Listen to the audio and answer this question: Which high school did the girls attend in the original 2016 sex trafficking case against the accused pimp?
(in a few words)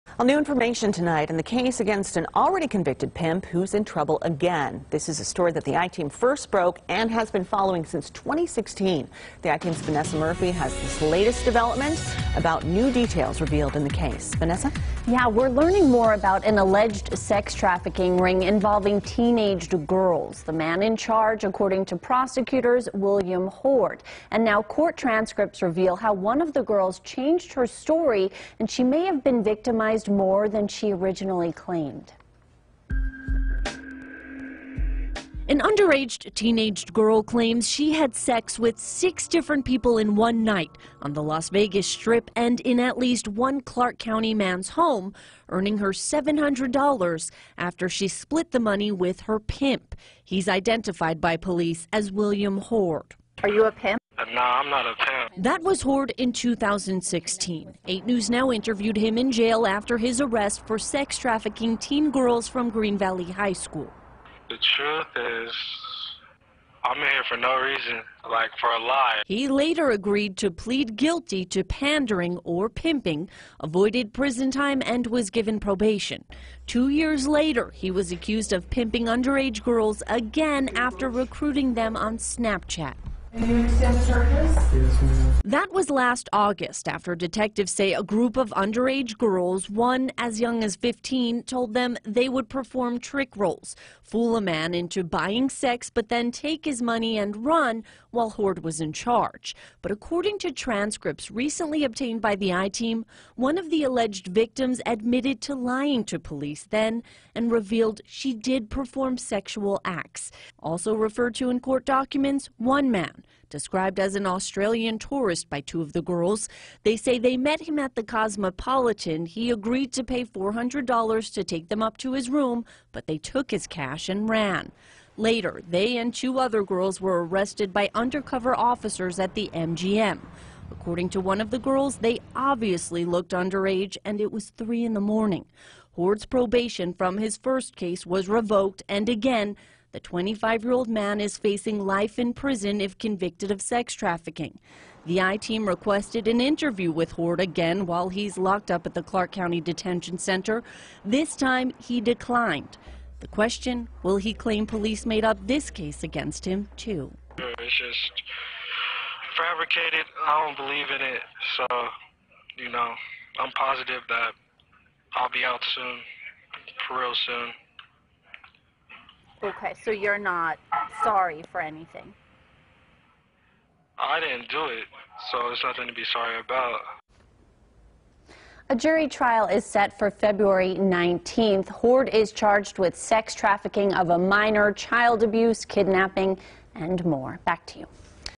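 Green Valley High School.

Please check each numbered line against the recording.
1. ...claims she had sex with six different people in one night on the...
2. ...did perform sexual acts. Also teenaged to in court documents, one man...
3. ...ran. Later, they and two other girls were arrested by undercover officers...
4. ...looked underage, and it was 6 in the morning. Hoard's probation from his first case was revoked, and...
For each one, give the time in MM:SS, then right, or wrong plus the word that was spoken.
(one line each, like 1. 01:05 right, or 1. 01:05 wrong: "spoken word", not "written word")
1. 00:37 right
2. 01:48 wrong: "referred", not "teenaged"
3. 02:04 right
4. 02:13 wrong: "3", not "6".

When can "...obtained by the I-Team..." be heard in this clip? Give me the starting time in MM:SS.
01:41.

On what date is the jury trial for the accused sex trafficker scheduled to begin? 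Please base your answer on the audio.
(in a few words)
February 19th.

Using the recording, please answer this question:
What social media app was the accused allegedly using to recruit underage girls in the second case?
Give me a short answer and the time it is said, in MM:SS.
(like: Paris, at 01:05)
Snapchat, at 01:22.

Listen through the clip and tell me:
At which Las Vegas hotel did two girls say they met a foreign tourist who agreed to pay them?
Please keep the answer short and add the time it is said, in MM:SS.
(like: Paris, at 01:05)
Cosmopolitan, at 01:58.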